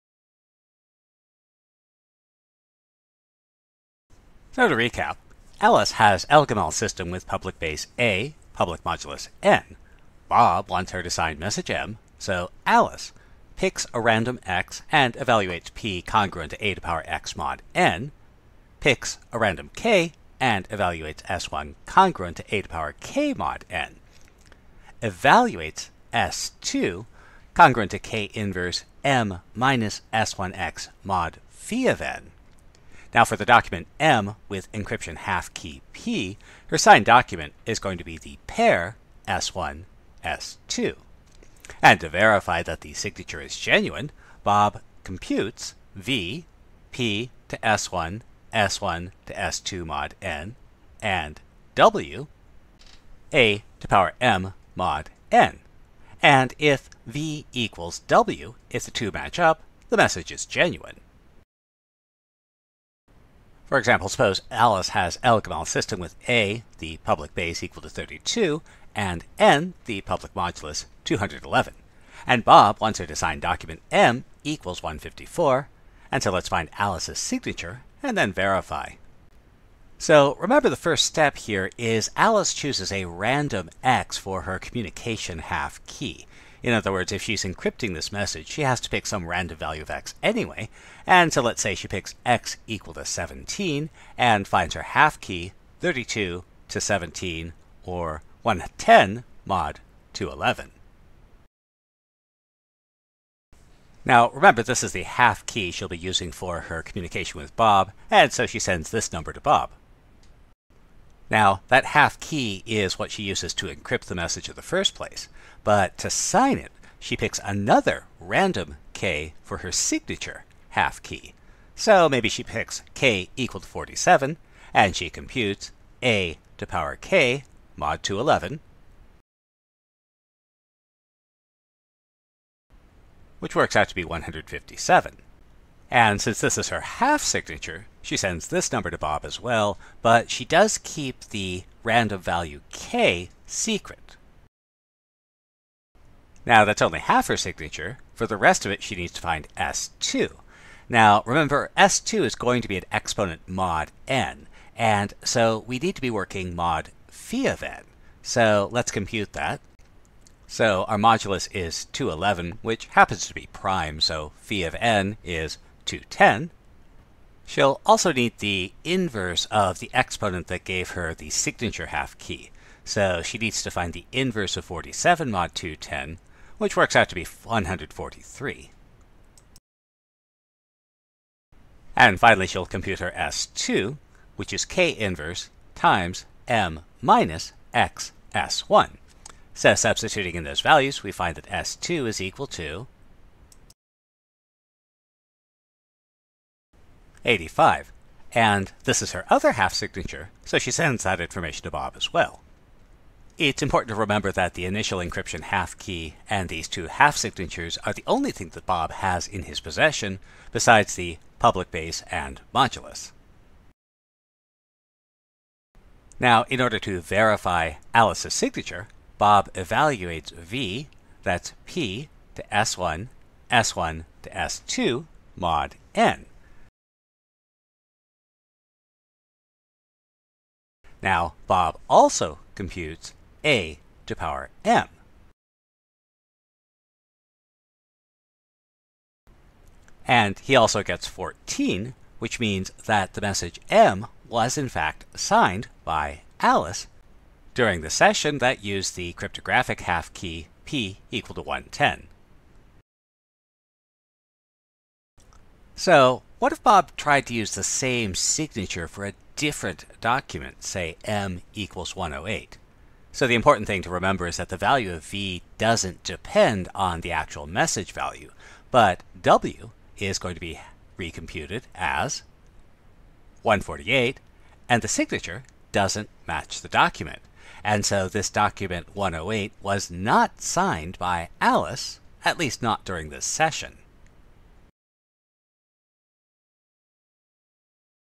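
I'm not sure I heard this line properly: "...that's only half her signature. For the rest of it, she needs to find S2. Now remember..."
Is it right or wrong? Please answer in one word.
right.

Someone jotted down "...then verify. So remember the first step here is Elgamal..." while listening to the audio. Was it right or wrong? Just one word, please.
wrong.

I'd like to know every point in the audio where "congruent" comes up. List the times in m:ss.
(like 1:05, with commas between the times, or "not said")
0:16, 0:21, 0:27.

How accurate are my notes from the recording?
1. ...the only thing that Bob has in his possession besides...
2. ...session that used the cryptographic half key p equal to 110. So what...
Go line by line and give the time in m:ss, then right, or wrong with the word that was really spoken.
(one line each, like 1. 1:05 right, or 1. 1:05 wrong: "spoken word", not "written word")
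1. 3:27 right
2. 4:07 right.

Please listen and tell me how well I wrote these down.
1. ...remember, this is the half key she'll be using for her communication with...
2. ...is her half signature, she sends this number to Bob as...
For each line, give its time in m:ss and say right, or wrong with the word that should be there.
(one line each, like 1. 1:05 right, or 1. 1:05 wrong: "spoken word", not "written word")
1. 1:44 right
2. 2:16 right.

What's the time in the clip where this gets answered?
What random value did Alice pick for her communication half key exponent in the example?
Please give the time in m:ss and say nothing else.
1:32.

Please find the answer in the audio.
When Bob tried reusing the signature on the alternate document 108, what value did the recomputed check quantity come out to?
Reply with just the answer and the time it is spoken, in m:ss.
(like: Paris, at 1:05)
148, at 4:33.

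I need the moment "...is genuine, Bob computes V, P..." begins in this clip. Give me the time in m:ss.
0:43.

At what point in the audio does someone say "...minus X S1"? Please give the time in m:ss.
3:07.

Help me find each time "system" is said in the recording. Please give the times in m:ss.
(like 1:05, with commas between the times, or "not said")
0:06, 1:05.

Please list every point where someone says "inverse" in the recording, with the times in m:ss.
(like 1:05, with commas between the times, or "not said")
0:28, 2:48, 2:54, 3:04.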